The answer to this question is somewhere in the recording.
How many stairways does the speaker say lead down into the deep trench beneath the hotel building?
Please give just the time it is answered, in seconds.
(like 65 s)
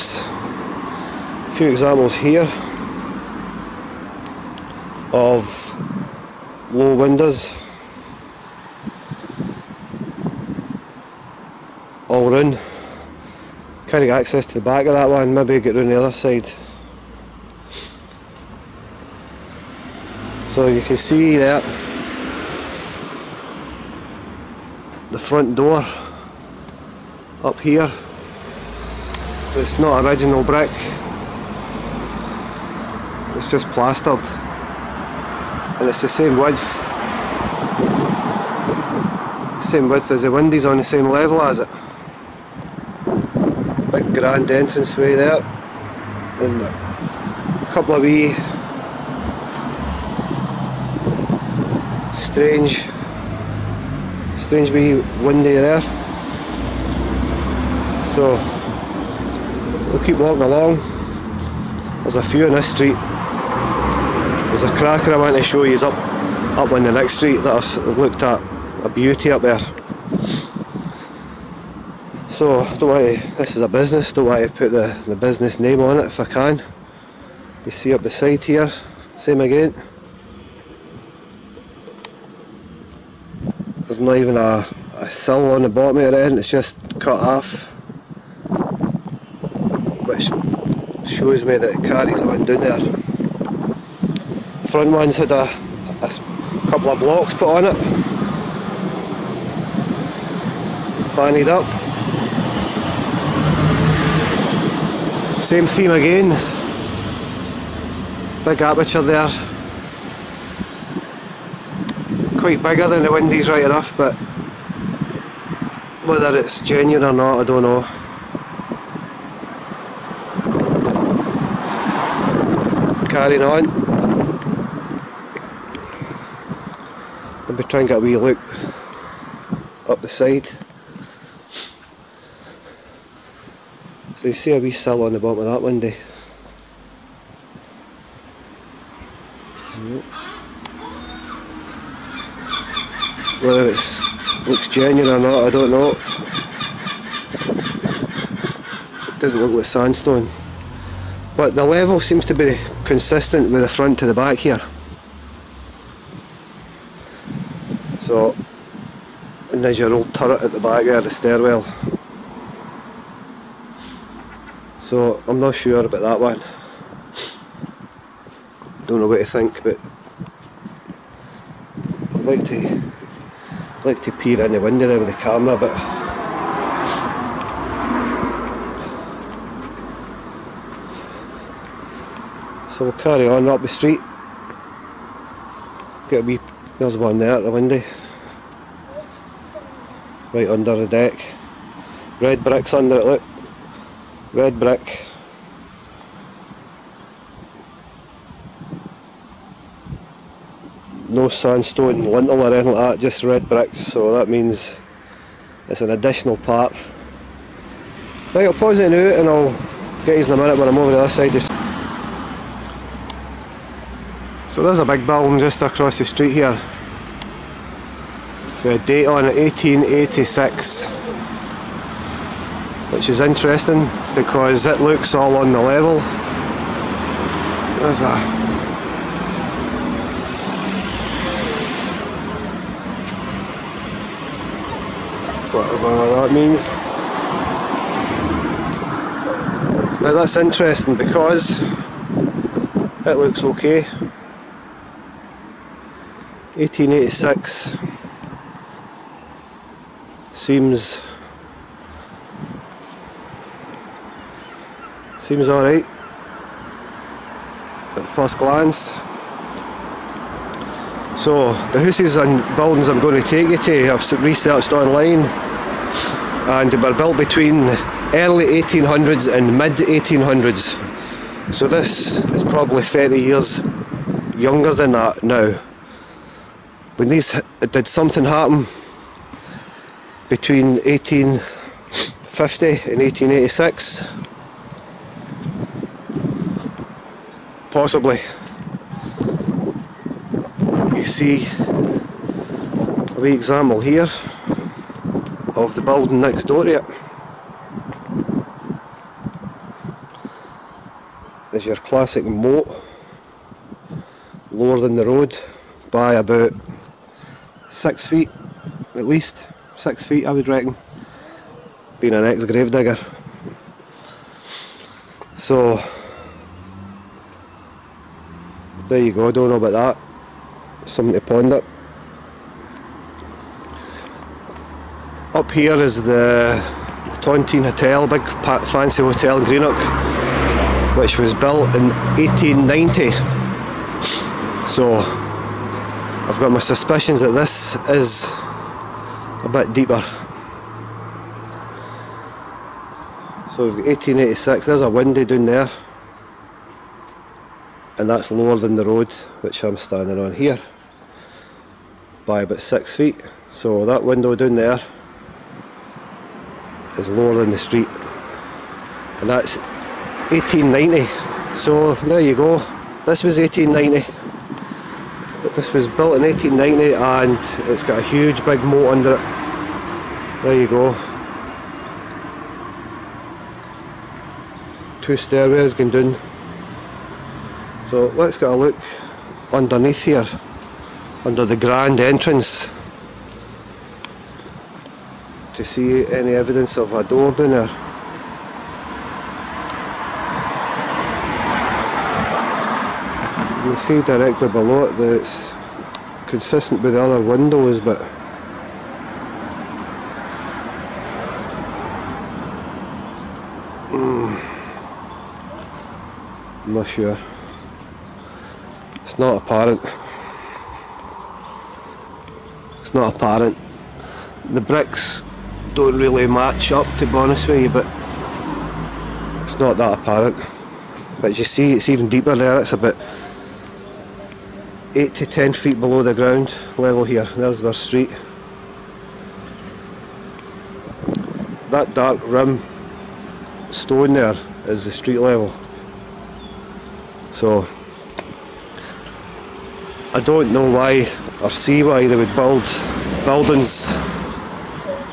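375 s.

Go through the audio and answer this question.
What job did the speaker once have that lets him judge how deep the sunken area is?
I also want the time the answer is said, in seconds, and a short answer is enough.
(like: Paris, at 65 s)
Gravedigger, at 312 s.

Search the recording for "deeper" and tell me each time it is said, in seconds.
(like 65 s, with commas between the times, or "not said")
339 s, 422 s.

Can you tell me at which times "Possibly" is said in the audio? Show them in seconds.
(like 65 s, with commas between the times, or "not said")
287 s.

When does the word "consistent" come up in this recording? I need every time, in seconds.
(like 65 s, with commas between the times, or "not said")
152 s, 396 s.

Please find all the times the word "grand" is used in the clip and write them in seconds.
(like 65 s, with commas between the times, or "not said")
44 s, 381 s.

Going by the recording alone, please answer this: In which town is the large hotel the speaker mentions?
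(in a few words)
Greenock.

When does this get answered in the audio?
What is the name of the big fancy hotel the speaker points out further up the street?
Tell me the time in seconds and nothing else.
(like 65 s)
327 s.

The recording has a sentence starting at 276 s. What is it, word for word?
When these, did something happen between 1850 and 1886?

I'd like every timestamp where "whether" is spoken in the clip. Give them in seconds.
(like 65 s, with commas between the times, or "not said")
116 s, 143 s.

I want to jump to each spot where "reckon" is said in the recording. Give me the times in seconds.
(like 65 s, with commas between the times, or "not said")
310 s.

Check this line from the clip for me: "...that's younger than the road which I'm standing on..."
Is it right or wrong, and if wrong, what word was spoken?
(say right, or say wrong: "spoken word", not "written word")
wrong: "lower", not "younger".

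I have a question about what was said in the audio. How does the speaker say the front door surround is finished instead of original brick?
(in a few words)
Plastered.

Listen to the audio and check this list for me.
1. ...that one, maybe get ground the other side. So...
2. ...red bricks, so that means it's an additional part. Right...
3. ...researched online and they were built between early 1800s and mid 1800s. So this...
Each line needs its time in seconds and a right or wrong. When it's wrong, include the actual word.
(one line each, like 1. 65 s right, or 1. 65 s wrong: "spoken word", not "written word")
1. 14 s wrong: "round", not "ground"
2. 203 s right
3. 264 s right.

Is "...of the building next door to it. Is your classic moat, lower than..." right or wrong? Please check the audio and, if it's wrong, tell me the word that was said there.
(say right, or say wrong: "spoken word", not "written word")
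right.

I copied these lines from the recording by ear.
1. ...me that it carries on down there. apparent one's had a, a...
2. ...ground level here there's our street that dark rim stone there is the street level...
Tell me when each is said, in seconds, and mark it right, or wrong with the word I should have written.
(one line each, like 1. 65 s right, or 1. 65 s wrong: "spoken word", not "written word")
1. 91 s wrong: "front", not "apparent"
2. 426 s right.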